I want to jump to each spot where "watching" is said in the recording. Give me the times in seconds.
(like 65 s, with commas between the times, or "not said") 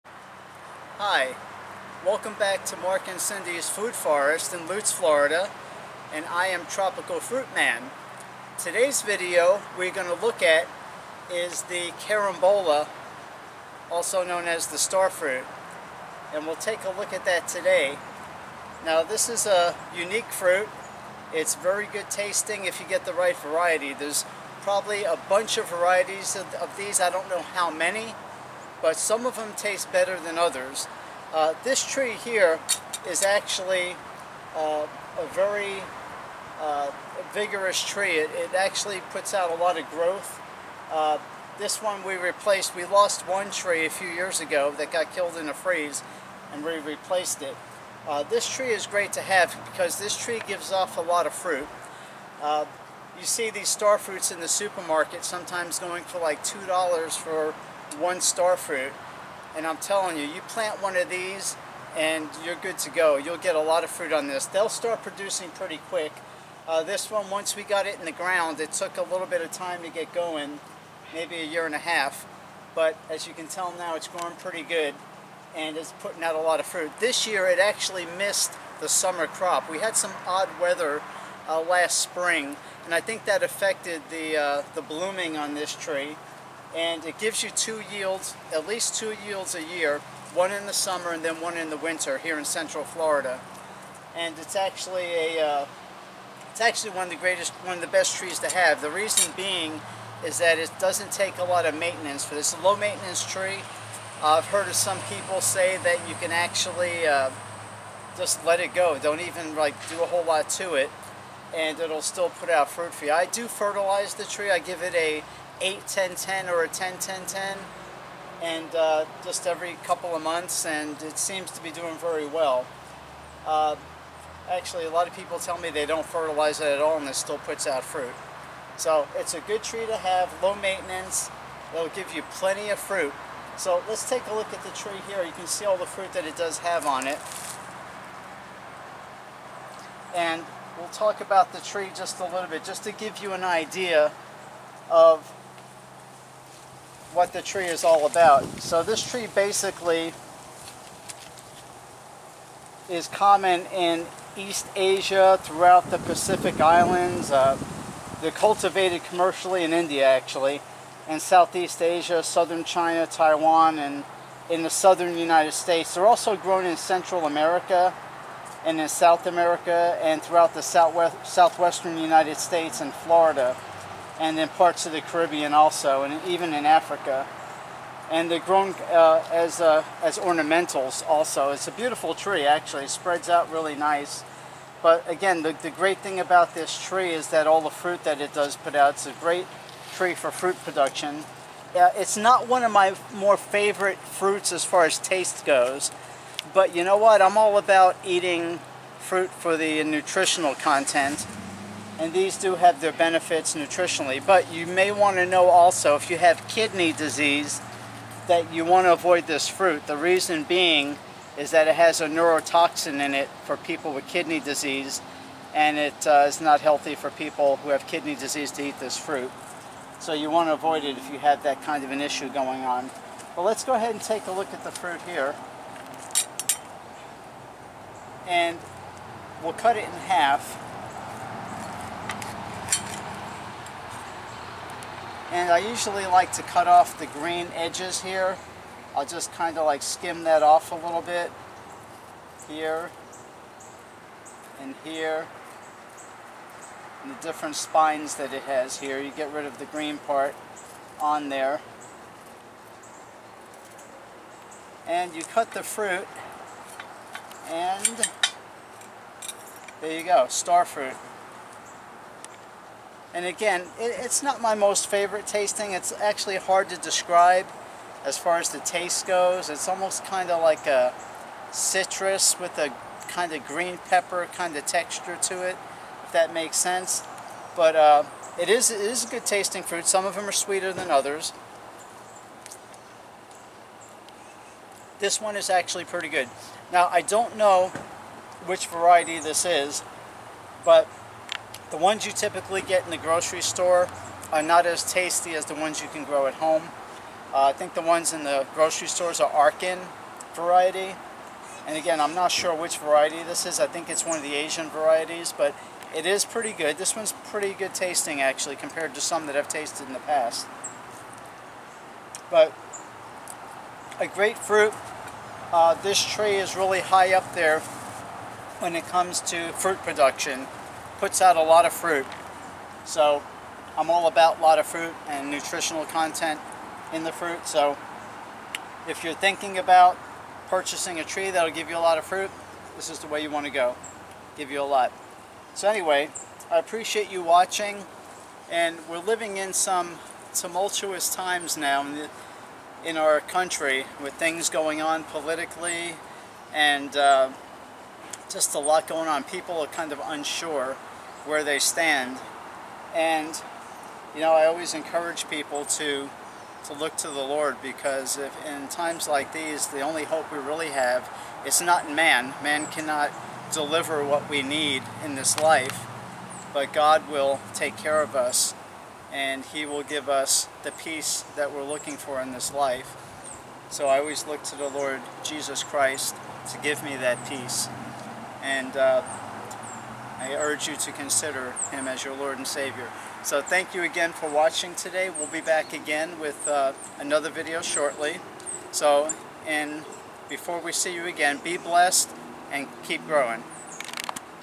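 337 s, 384 s.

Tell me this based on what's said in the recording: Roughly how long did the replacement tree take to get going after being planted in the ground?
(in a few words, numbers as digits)
a year and a half.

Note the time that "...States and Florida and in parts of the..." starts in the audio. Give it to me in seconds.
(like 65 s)
172 s.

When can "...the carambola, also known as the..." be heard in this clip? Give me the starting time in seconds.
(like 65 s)
11 s.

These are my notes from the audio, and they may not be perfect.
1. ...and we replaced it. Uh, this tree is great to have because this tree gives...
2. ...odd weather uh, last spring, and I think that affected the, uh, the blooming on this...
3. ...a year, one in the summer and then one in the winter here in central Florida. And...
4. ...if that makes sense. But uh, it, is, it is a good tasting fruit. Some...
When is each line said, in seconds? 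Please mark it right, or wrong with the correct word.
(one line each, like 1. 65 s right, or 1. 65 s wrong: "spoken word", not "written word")
1. 46 s right
2. 80 s right
3. 89 s right
4. 276 s right.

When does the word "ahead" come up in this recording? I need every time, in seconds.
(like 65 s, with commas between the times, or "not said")
223 s.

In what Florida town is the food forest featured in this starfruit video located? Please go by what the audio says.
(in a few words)
Lutz.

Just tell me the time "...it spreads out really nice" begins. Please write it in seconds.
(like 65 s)
182 s.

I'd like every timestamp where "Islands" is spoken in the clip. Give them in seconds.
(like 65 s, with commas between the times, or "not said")
156 s.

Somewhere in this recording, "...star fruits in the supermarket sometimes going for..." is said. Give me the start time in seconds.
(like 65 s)
53 s.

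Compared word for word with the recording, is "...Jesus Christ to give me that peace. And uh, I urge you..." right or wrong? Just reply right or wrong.
right.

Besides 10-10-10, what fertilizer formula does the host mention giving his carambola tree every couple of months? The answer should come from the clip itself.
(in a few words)
8-10-10.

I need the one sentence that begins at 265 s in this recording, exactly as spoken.
It's actually hard to describe as far as the taste goes.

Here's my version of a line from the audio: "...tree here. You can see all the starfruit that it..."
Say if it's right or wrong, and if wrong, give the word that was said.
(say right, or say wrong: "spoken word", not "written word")
wrong: "fruit", not "starfruit".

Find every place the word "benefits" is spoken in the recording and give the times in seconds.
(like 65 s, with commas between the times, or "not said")
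202 s.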